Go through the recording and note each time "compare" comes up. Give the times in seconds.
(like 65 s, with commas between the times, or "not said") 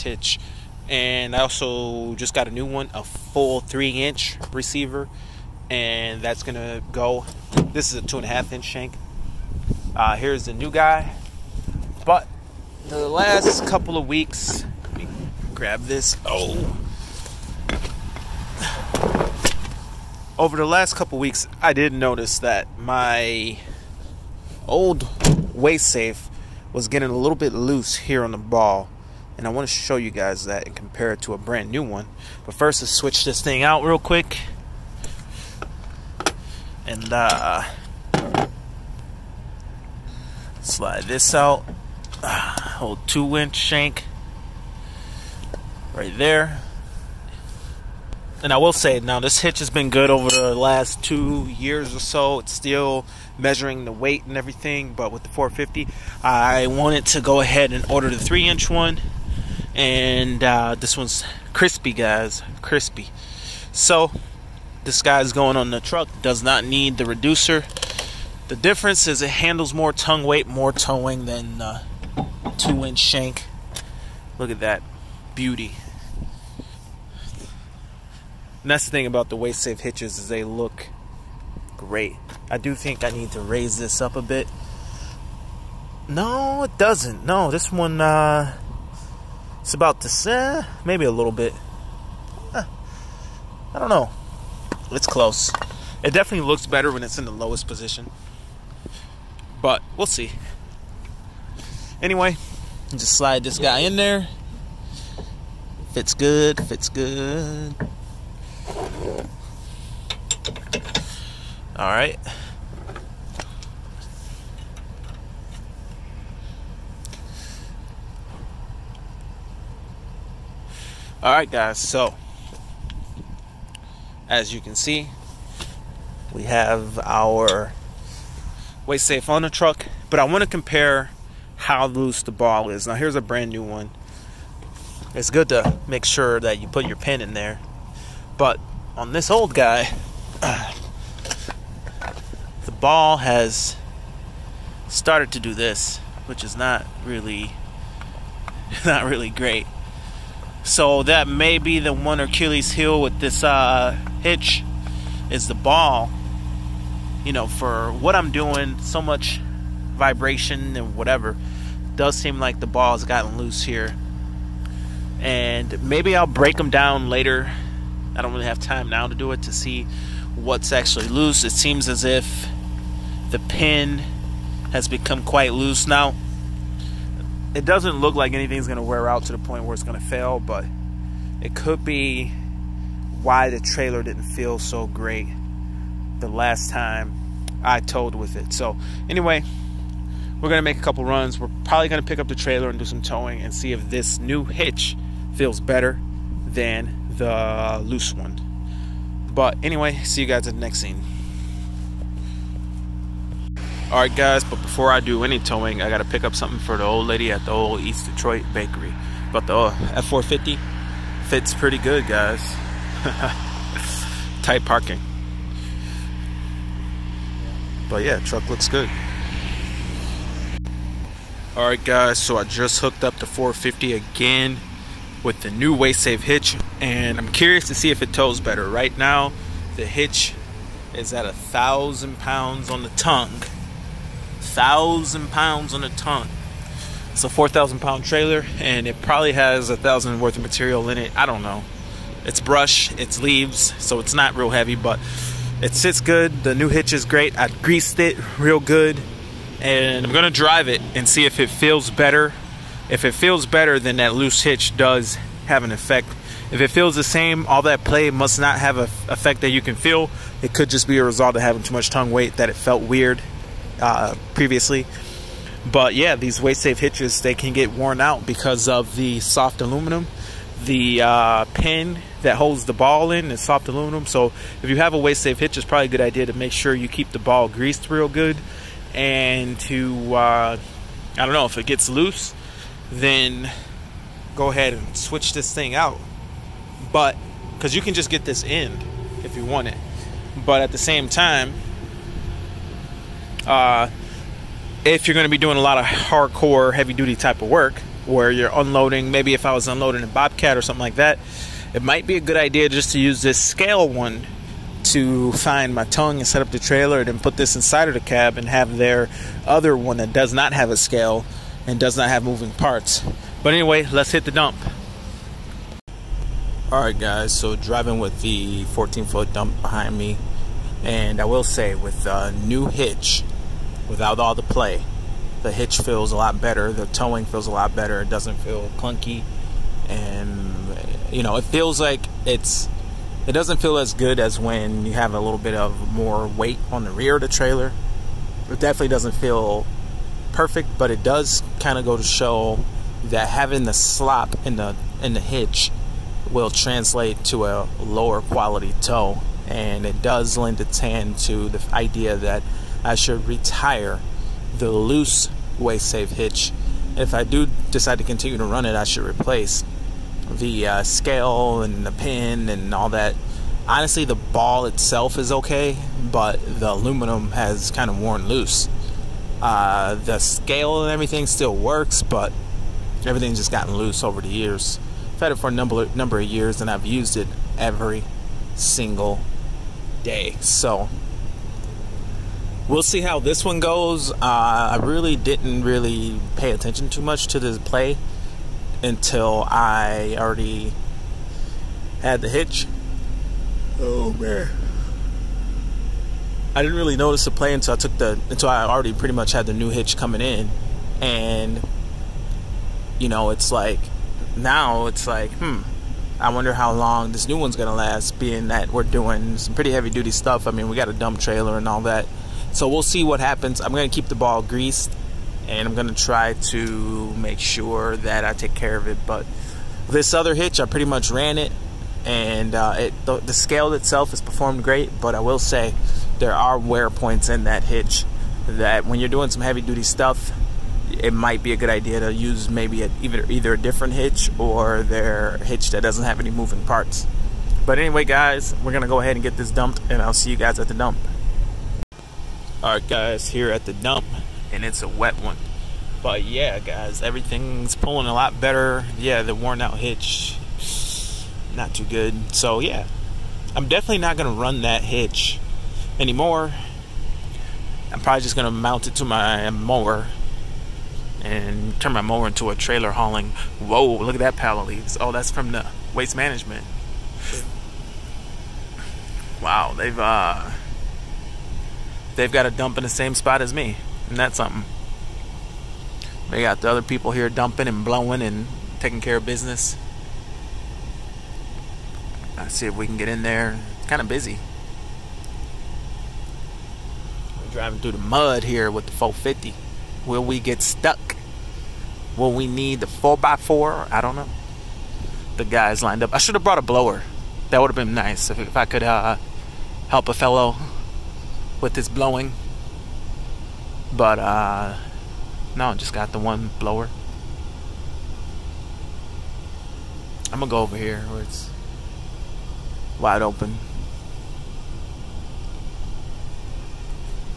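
30 s, 130 s.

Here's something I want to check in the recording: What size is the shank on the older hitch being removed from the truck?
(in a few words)
2.5-inch.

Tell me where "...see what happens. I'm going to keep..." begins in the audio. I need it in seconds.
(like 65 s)
412 s.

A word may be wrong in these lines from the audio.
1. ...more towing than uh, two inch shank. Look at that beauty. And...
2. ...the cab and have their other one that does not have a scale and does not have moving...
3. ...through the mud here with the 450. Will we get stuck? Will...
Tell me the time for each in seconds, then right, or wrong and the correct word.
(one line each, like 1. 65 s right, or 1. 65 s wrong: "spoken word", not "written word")
1. 70 s right
2. 307 s right
3. 487 s right.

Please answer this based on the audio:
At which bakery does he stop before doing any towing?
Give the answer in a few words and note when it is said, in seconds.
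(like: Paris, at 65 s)
East Detroit bakery, at 207 s.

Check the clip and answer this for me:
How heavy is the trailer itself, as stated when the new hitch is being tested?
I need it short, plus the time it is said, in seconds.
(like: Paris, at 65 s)
4,000 pounds, at 237 s.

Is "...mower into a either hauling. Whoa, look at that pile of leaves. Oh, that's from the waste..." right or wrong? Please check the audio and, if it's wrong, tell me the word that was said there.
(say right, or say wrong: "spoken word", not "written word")
wrong: "trailer", not "either".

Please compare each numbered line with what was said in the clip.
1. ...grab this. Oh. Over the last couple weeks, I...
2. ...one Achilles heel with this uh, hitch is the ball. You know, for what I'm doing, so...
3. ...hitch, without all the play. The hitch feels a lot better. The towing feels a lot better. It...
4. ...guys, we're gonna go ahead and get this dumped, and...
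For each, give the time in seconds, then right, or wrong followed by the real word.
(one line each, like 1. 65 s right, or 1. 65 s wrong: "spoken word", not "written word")
1. 15 s right
2. 151 s right
3. 322 s right
4. 438 s right.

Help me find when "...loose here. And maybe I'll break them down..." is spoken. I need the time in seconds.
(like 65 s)
163 s.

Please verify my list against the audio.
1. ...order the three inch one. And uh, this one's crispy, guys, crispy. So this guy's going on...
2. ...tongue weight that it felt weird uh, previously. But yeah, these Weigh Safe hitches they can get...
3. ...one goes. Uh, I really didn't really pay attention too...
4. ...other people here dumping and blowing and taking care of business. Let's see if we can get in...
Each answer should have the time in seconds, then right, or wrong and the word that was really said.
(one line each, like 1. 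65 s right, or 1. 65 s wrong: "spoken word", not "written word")
1. 57 s right
2. 261 s right
3. 383 s right
4. 476 s right.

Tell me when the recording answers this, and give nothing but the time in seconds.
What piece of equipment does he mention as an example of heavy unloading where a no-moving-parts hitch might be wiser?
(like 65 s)
300 s.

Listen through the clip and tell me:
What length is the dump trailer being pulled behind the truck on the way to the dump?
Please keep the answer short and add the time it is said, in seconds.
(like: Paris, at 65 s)
14 foot, at 318 s.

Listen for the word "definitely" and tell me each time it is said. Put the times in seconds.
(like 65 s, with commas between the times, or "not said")
96 s, 338 s, 453 s.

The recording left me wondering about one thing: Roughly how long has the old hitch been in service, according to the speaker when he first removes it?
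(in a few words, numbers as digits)
2 years.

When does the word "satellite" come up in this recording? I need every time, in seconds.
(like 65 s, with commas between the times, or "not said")
not said.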